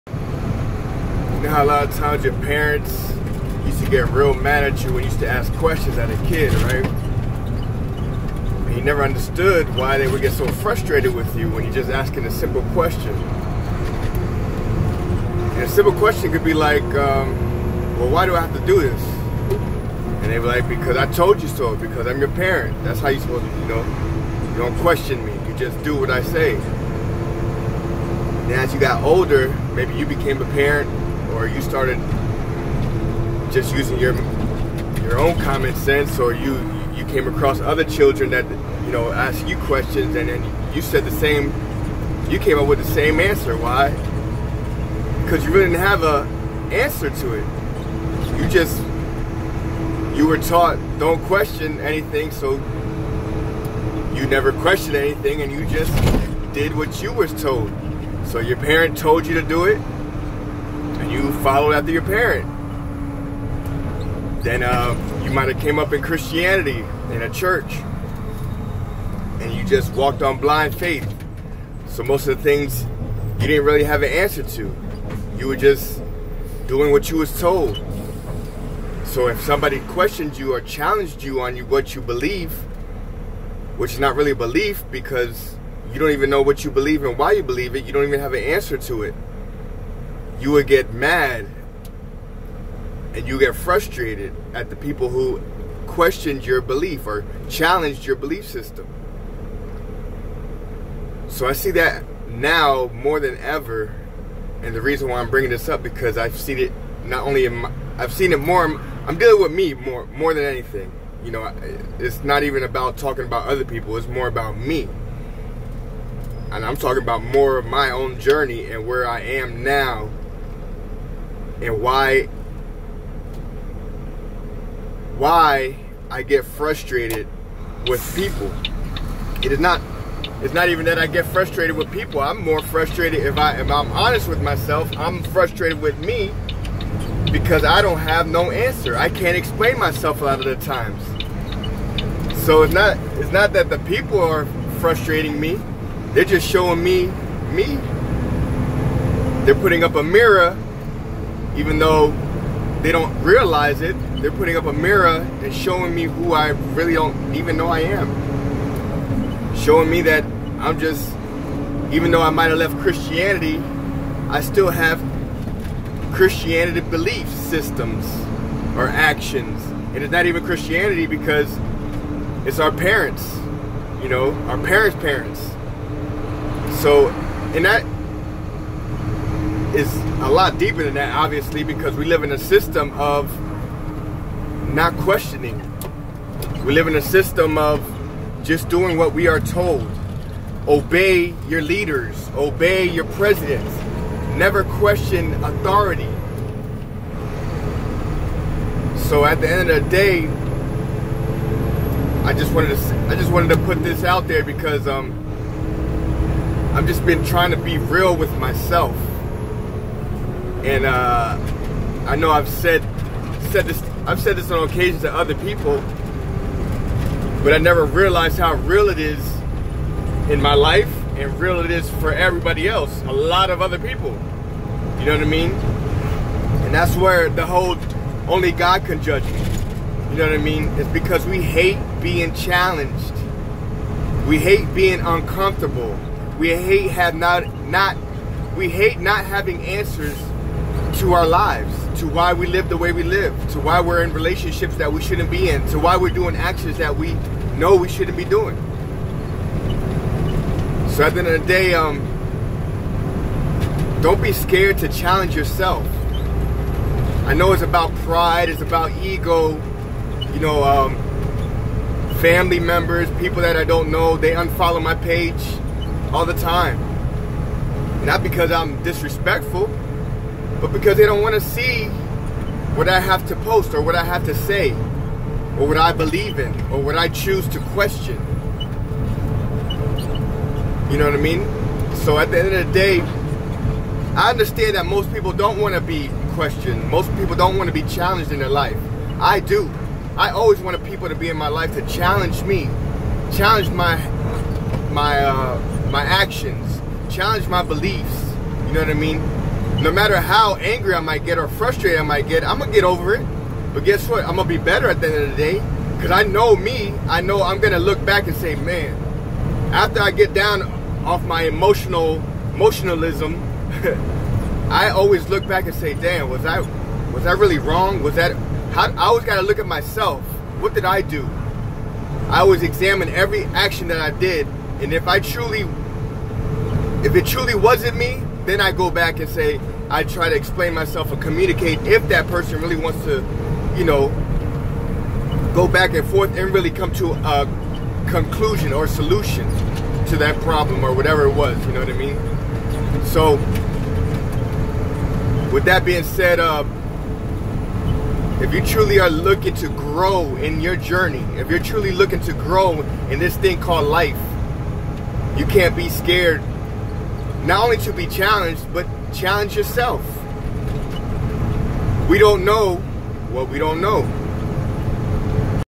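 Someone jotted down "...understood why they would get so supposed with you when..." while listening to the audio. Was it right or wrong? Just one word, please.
wrong.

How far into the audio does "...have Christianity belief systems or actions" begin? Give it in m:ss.
2:44.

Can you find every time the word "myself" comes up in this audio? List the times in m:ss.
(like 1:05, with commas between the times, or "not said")
2:14, 2:19, 3:28, 5:19, 5:30.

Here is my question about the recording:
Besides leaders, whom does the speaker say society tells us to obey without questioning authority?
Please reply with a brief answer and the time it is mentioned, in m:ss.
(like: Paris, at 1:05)
presidents, at 3:13.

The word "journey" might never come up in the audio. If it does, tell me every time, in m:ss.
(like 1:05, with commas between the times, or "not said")
1:58, 5:50.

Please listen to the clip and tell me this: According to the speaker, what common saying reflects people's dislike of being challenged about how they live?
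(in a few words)
only God can judge me.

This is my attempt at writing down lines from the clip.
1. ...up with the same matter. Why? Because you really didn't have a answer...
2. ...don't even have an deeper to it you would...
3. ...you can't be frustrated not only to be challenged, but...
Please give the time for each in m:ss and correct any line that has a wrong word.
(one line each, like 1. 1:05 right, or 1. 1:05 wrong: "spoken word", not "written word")
1. 0:42 wrong: "answer", not "matter"
2. 1:27 wrong: "answer", not "deeper"
3. 5:55 wrong: "scared", not "frustrated".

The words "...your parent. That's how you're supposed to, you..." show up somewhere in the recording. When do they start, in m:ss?
0:22.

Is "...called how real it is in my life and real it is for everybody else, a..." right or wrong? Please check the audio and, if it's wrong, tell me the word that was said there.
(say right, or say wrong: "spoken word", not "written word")
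wrong: "realized", not "called".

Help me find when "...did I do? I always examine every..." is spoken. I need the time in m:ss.
5:20.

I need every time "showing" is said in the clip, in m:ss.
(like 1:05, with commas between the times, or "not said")
2:26, 2:35, 2:39.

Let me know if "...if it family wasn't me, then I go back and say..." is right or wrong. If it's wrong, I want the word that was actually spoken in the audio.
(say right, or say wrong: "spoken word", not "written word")
wrong: "truly", not "family".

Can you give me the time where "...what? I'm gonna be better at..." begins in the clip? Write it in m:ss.
5:04.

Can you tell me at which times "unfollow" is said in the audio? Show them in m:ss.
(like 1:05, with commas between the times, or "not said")
4:24.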